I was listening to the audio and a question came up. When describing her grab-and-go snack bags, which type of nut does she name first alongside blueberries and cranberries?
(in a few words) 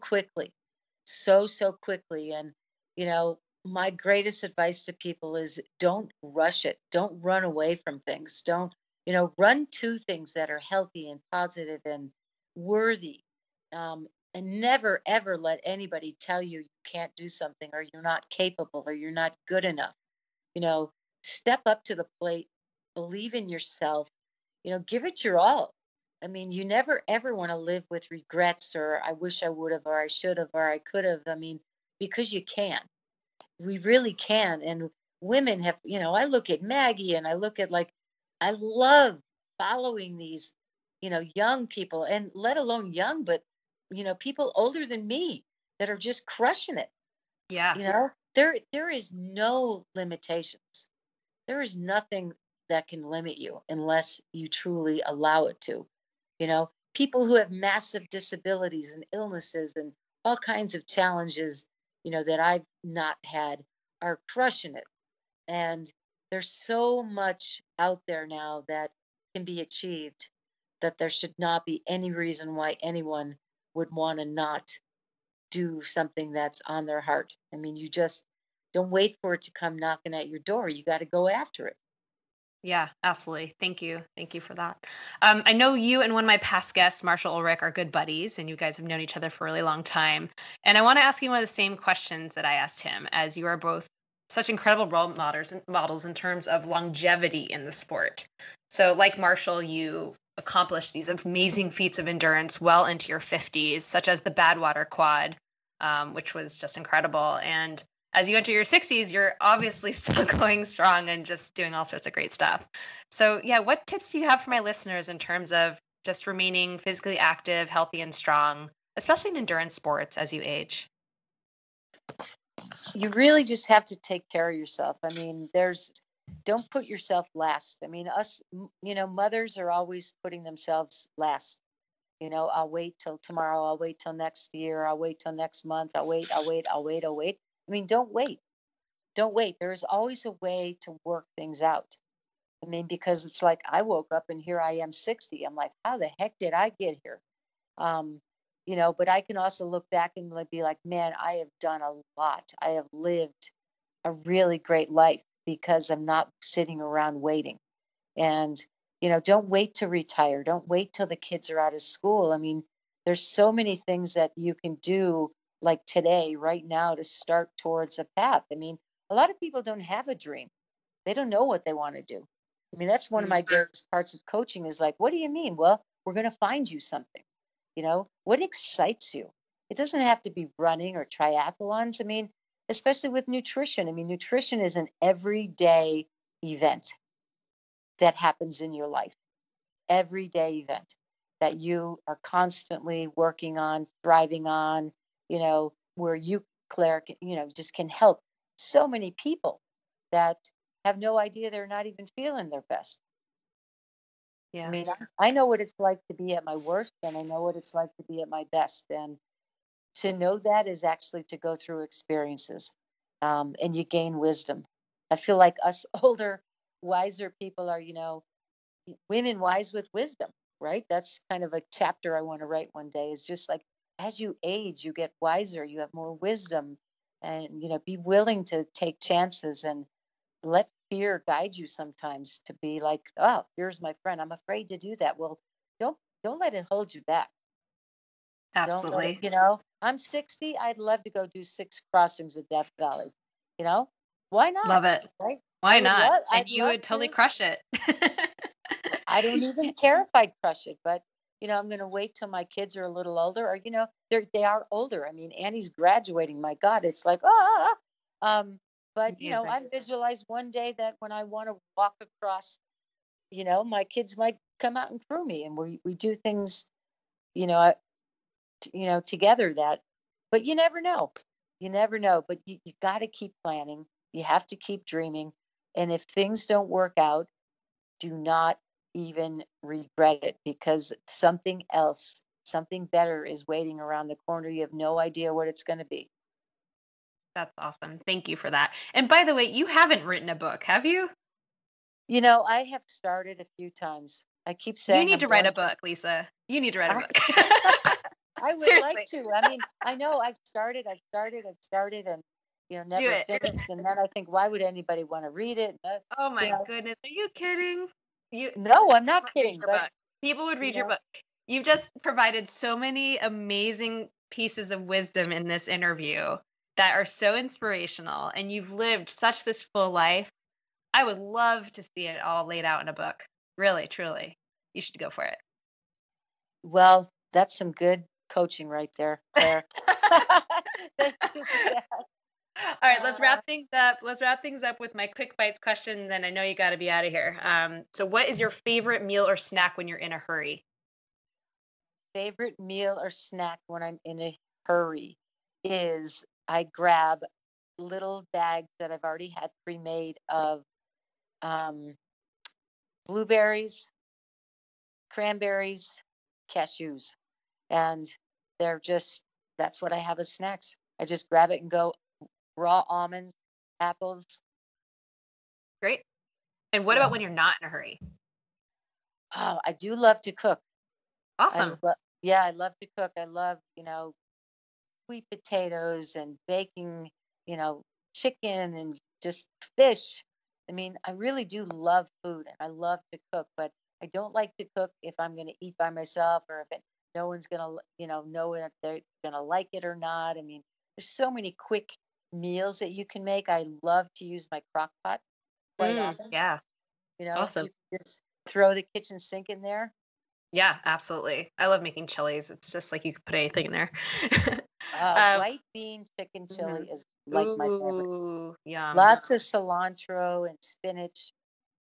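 Cashews.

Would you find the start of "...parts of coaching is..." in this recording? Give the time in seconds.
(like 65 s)
173 s.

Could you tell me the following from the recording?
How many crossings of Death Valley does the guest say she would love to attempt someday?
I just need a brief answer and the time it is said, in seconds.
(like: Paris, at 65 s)
6, at 241 s.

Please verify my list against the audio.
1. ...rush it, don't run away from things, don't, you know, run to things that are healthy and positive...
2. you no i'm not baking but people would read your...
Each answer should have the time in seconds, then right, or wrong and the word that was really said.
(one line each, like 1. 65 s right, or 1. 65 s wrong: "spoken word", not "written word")
1. 6 s right
2. 308 s wrong: "kidding", not "baking".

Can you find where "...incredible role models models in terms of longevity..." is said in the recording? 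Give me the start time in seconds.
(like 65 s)
94 s.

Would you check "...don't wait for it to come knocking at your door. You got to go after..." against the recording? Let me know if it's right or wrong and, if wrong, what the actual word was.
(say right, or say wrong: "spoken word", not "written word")
right.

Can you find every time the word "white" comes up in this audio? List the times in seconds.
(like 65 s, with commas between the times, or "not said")
405 s.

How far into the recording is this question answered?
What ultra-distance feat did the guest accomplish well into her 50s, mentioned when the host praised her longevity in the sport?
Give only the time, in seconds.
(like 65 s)
104 s.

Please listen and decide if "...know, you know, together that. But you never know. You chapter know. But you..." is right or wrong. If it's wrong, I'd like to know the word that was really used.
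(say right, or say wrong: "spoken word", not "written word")
wrong: "never", not "chapter".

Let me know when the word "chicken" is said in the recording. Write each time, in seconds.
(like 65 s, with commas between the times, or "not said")
378 s, 406 s.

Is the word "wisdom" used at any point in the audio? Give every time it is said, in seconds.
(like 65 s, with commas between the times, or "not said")
214 s, 219 s, 226 s, 314 s.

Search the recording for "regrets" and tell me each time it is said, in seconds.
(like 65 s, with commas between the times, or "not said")
28 s, 279 s.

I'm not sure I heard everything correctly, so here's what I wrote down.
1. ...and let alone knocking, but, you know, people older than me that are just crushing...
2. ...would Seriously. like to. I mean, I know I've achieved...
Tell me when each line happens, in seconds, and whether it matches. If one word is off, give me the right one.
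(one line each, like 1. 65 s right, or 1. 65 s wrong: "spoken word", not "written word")
1. 42 s wrong: "young", not "knocking"
2. 298 s wrong: "started", not "achieved".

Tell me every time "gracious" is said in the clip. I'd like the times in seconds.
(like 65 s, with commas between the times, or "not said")
not said.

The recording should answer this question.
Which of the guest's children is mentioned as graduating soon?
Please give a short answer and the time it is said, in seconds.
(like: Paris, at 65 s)
Annie, at 255 s.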